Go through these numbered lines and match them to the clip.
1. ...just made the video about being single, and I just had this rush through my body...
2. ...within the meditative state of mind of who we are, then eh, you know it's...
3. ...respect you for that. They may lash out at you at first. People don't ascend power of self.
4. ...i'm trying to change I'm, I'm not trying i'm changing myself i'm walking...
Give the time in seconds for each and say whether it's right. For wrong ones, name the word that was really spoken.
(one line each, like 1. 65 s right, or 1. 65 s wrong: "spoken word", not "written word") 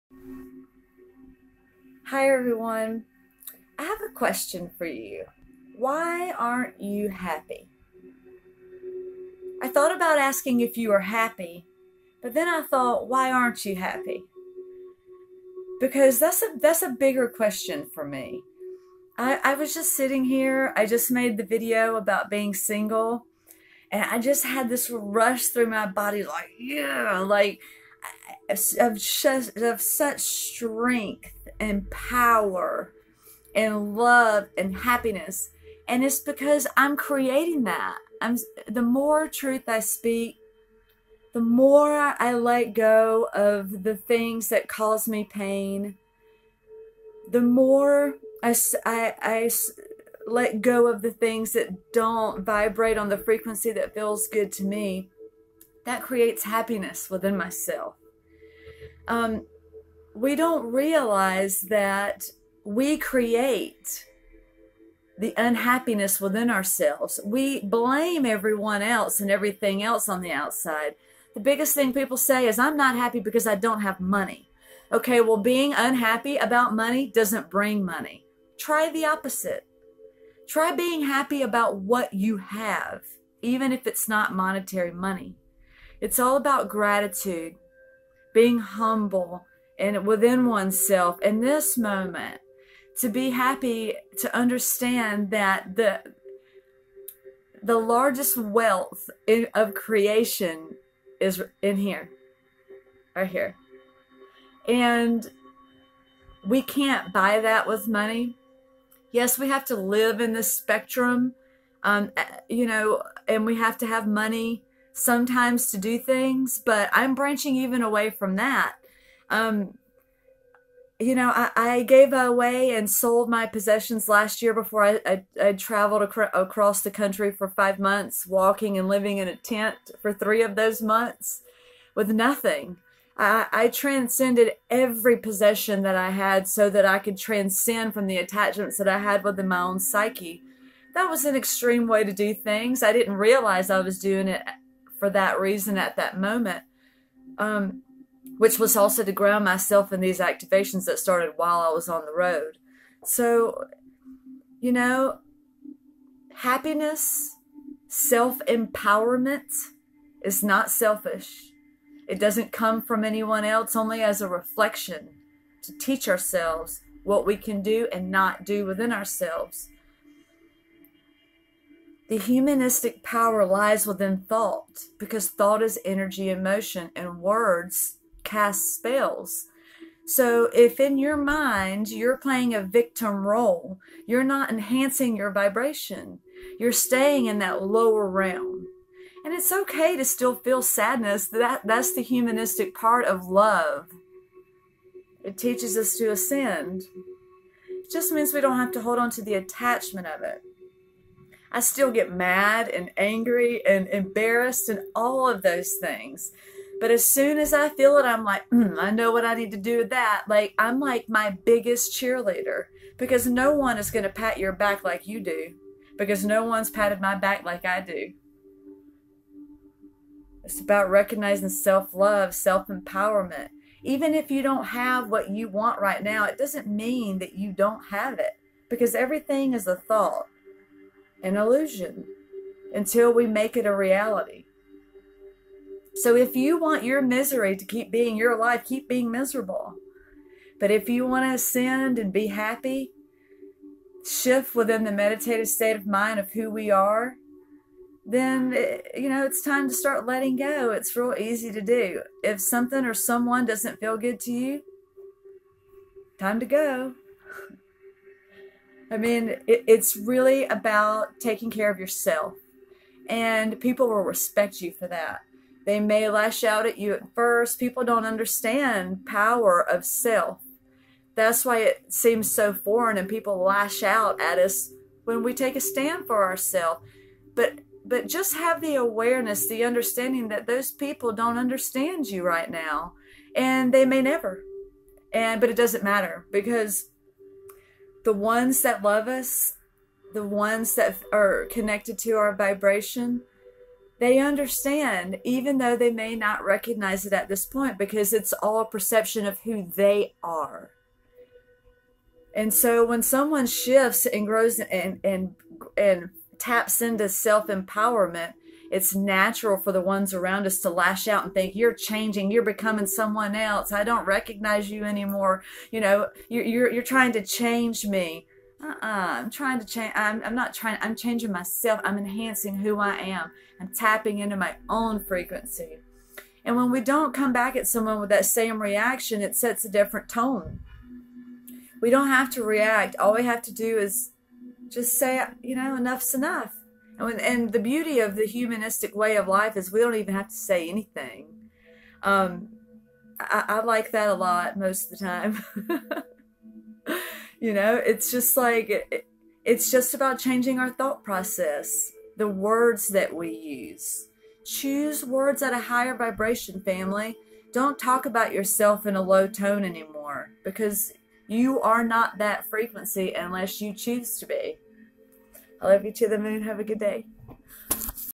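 1. 20 s right
2. 244 s right
3. 264 s wrong: "understand", not "ascend"
4. 318 s wrong: "enhancing", not "walking".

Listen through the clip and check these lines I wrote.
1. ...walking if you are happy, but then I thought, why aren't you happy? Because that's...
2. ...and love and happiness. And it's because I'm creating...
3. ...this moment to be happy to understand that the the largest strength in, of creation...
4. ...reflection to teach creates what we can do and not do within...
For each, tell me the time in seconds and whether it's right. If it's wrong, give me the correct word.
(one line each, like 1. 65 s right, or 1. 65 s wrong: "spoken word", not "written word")
1. 10 s wrong: "asking", not "walking"
2. 33 s right
3. 91 s wrong: "wealth", not "strength"
4. 164 s wrong: "ourselves", not "creates".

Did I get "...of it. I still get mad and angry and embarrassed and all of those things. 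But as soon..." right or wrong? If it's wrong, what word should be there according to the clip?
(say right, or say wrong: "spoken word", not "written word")
right.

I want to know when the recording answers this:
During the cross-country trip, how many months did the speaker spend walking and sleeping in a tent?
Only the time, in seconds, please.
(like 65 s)
130 s.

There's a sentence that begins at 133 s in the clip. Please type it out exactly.
I, transcended every possession that I had so that I could transcend from the attachments that I had within my own psyche.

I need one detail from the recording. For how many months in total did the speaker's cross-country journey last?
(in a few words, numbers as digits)
5.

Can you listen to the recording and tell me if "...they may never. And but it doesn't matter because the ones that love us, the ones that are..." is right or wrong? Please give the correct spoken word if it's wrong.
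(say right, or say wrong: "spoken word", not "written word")
right.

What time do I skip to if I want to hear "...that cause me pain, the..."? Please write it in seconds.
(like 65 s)
44 s.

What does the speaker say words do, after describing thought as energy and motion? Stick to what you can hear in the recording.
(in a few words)
cast spells.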